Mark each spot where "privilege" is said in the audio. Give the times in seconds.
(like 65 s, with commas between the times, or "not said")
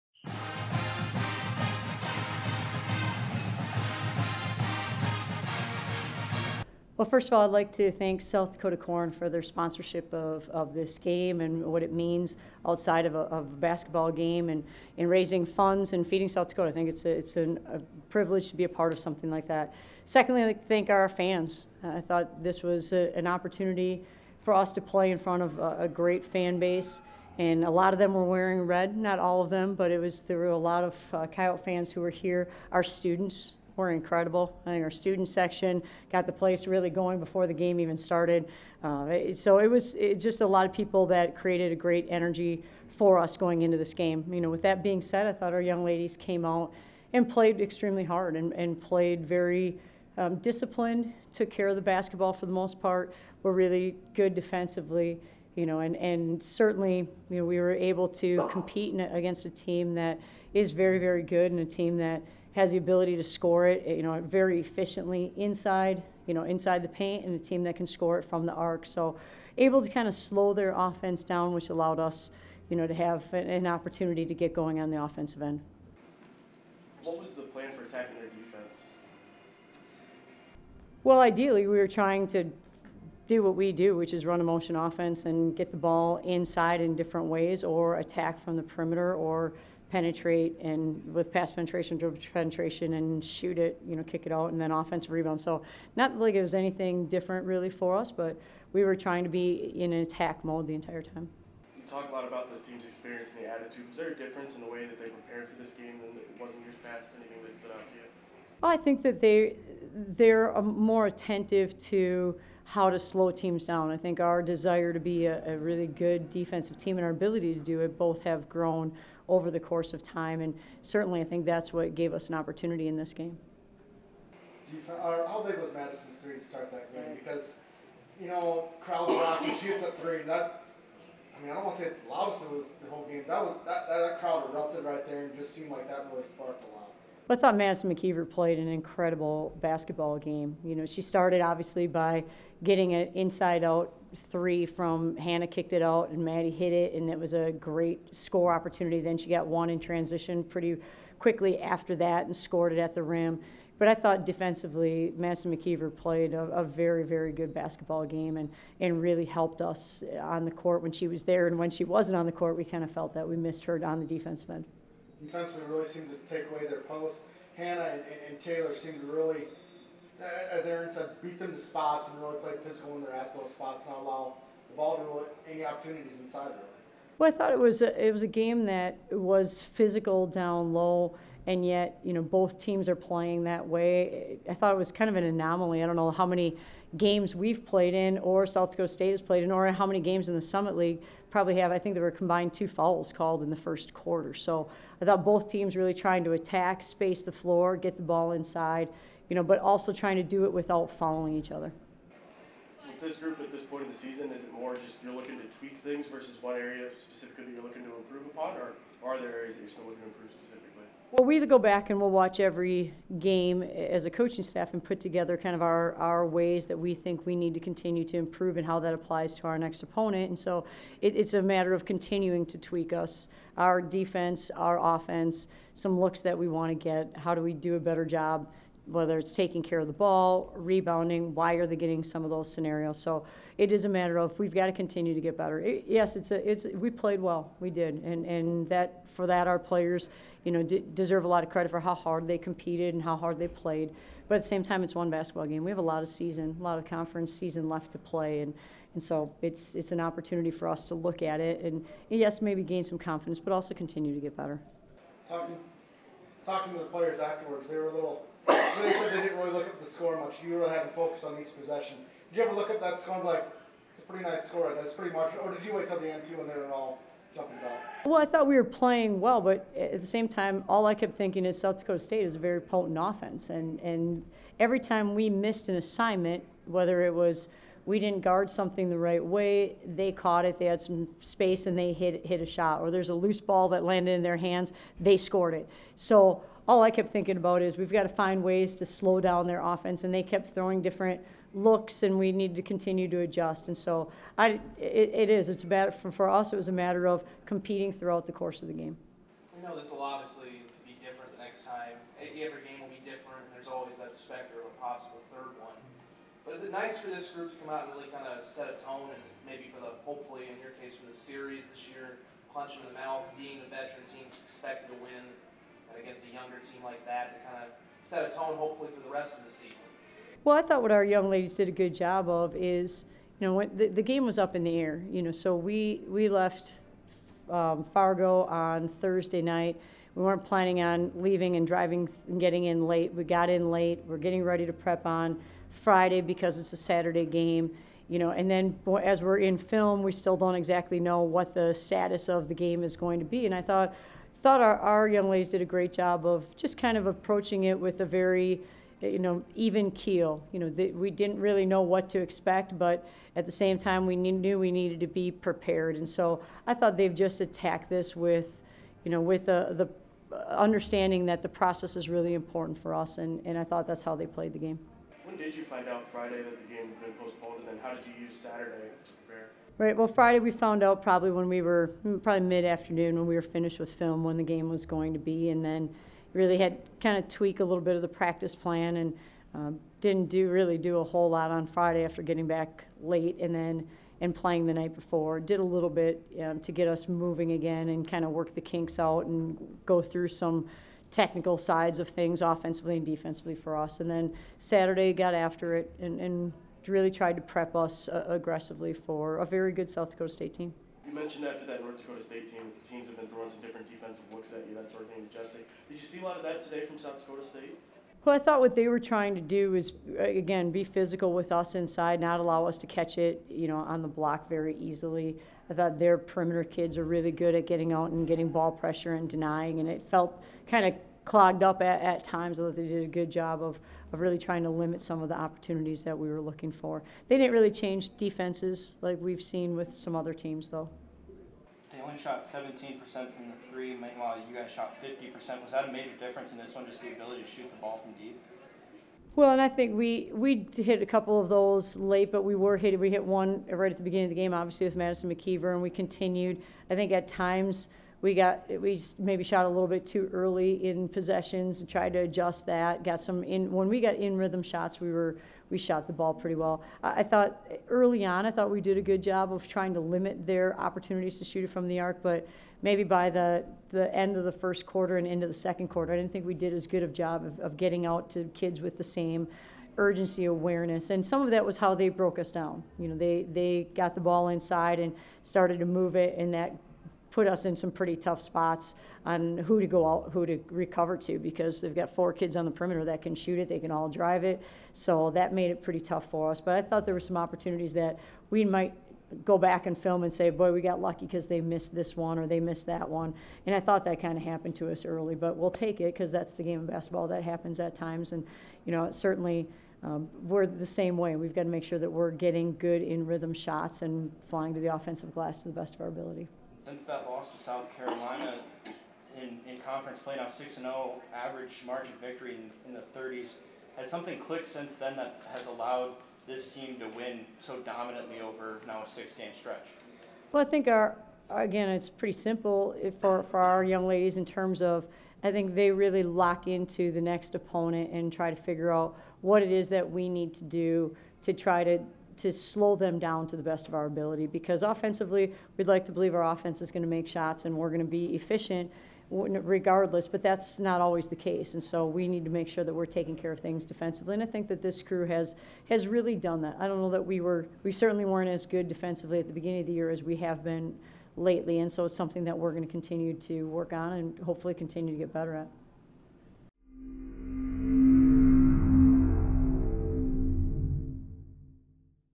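18 s.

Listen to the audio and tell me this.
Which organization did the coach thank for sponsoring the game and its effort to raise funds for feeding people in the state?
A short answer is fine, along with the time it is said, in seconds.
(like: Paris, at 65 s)
South Dakota Corn, at 8 s.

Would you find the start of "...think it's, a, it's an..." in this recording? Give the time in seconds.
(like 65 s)
16 s.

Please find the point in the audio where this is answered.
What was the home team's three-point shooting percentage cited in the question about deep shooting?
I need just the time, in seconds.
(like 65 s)
435 s.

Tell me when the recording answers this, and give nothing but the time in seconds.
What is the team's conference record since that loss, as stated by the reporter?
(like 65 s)
510 s.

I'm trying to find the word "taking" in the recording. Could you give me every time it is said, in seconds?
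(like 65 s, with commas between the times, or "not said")
229 s, 543 s.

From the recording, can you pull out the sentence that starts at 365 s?
When did you find out Friday that the game had been postponed, and then how did you use Saturday to prepare?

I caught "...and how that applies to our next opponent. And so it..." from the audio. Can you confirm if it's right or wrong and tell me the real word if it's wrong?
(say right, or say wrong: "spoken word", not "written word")
right.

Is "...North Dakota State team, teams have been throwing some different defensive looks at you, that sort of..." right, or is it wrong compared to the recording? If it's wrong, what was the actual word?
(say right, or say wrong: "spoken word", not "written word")
right.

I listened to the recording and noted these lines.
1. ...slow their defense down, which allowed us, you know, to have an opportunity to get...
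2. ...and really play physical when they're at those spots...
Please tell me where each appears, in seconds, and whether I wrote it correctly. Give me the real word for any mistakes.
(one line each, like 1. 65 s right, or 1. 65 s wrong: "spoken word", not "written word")
1. 70 s wrong: "offense", not "defense"
2. 172 s right.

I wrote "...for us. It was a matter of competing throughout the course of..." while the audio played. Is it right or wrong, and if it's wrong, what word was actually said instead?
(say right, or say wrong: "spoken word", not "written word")
right.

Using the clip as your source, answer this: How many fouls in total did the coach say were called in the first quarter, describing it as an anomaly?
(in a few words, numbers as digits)
2.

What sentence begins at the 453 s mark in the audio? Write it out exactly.
Got some in when we got in rhythm shots, we were we shot the ball pretty well.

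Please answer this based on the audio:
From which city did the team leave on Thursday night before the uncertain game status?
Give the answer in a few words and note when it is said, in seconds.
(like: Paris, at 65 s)
Fargo, at 327 s.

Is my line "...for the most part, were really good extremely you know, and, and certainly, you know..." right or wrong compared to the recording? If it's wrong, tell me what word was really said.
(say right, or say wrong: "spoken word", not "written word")
wrong: "defensively", not "extremely".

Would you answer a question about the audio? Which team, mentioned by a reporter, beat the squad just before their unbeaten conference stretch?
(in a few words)
South Carolina.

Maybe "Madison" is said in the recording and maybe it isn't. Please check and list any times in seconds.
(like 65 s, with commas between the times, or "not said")
125 s, 137 s, 155 s, 444 s.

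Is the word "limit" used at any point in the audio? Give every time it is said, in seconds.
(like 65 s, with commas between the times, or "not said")
424 s, 459 s.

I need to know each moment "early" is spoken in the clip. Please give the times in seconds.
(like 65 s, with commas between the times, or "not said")
450 s, 457 s, 495 s.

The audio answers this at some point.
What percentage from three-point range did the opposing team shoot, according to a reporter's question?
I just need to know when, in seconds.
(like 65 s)
432 s.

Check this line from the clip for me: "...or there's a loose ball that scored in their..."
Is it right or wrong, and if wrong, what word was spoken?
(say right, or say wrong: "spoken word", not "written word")
wrong: "landed", not "scored".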